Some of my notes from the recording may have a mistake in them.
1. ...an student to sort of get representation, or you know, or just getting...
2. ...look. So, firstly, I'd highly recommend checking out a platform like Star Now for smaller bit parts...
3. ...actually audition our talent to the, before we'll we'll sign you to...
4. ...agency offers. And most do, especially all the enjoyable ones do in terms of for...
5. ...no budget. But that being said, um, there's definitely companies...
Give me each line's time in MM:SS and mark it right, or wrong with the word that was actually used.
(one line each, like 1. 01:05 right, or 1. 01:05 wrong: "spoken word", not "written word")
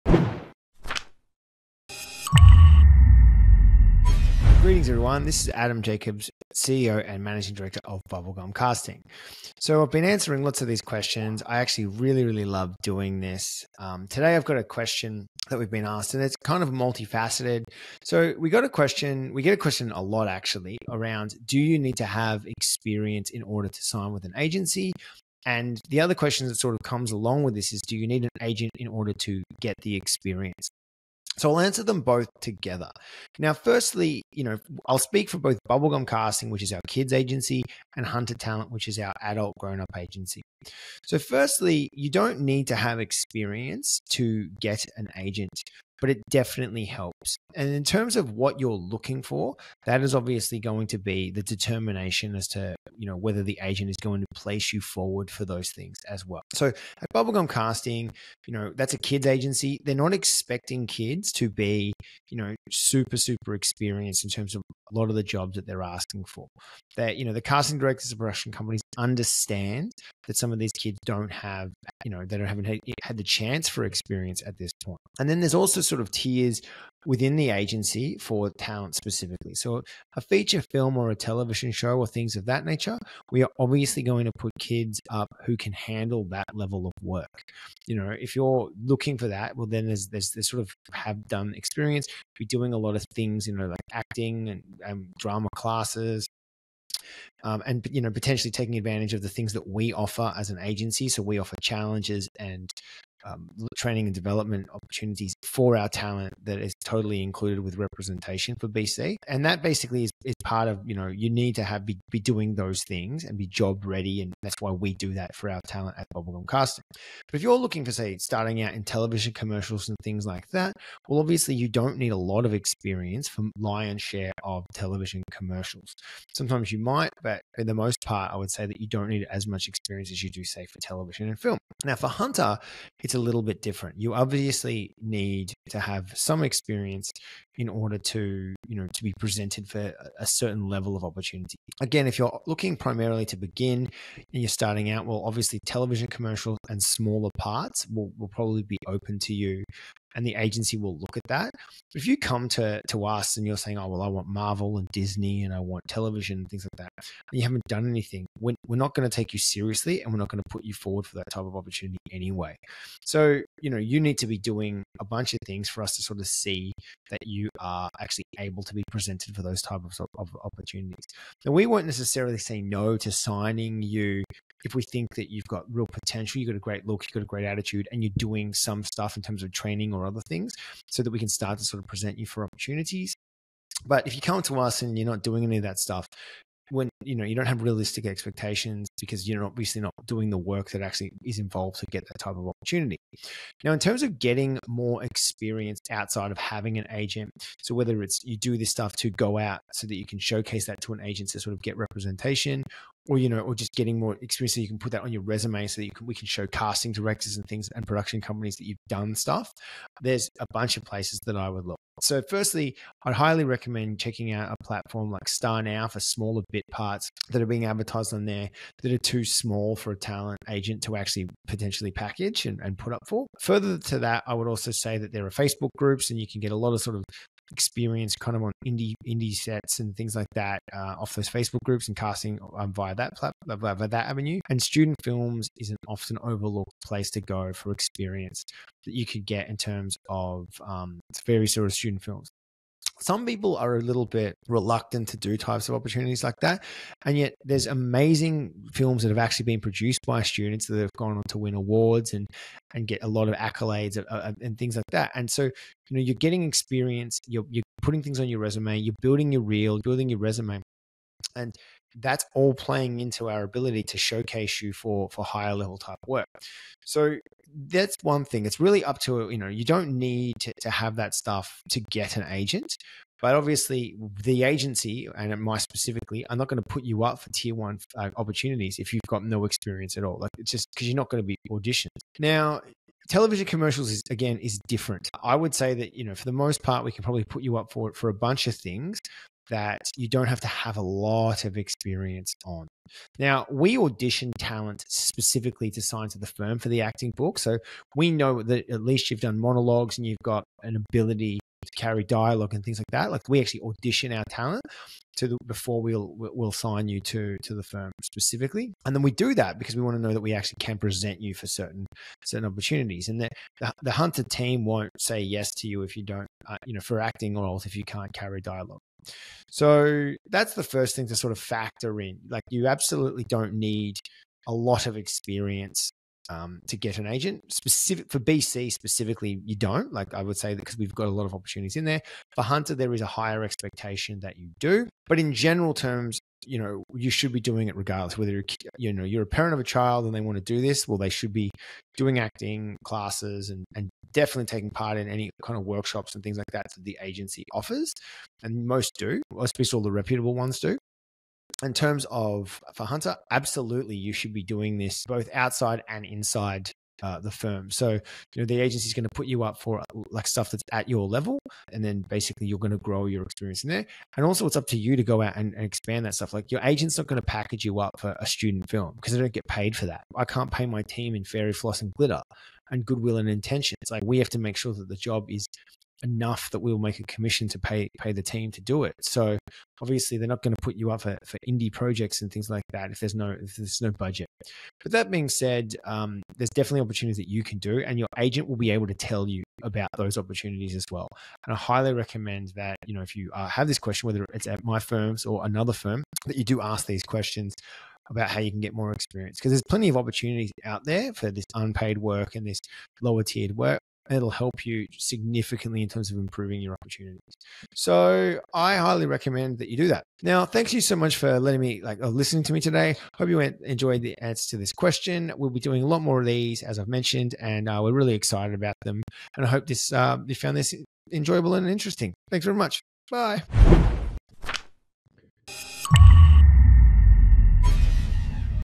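1. 03:20 wrong: "agent", not "student"
2. 03:31 right
3. 05:03 right
4. 05:47 wrong: "reputable", not "enjoyable"
5. 06:23 wrong: "opportunities", not "companies".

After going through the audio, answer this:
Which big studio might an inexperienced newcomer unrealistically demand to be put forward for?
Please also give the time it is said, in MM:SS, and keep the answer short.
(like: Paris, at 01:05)
Marvel, at 02:34.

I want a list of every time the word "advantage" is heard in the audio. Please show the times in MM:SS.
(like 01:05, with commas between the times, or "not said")
01:38.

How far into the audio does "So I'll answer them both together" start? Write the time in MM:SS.
00:31.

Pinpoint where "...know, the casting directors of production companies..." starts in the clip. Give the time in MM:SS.
01:07.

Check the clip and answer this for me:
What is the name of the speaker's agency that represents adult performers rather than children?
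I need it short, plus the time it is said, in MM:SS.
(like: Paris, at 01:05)
Hunter Talent, at 00:38.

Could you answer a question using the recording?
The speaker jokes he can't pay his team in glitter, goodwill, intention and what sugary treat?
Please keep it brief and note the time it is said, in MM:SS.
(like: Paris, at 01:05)
Fairy floss, at 06:11.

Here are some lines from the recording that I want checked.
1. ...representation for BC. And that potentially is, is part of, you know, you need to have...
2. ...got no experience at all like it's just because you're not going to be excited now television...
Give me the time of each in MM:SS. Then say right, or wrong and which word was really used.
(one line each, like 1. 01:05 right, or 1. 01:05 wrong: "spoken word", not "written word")
1. 01:47 wrong: "basically", not "potentially"
2. 04:39 wrong: "auditioned", not "excited".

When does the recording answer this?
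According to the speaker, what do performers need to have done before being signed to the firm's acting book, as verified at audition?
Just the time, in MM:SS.
04:59.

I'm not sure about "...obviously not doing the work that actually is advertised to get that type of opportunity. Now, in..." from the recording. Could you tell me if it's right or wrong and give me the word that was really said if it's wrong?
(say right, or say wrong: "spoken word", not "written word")
wrong: "involved", not "advertised".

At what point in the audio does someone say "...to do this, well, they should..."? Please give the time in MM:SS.
05:40.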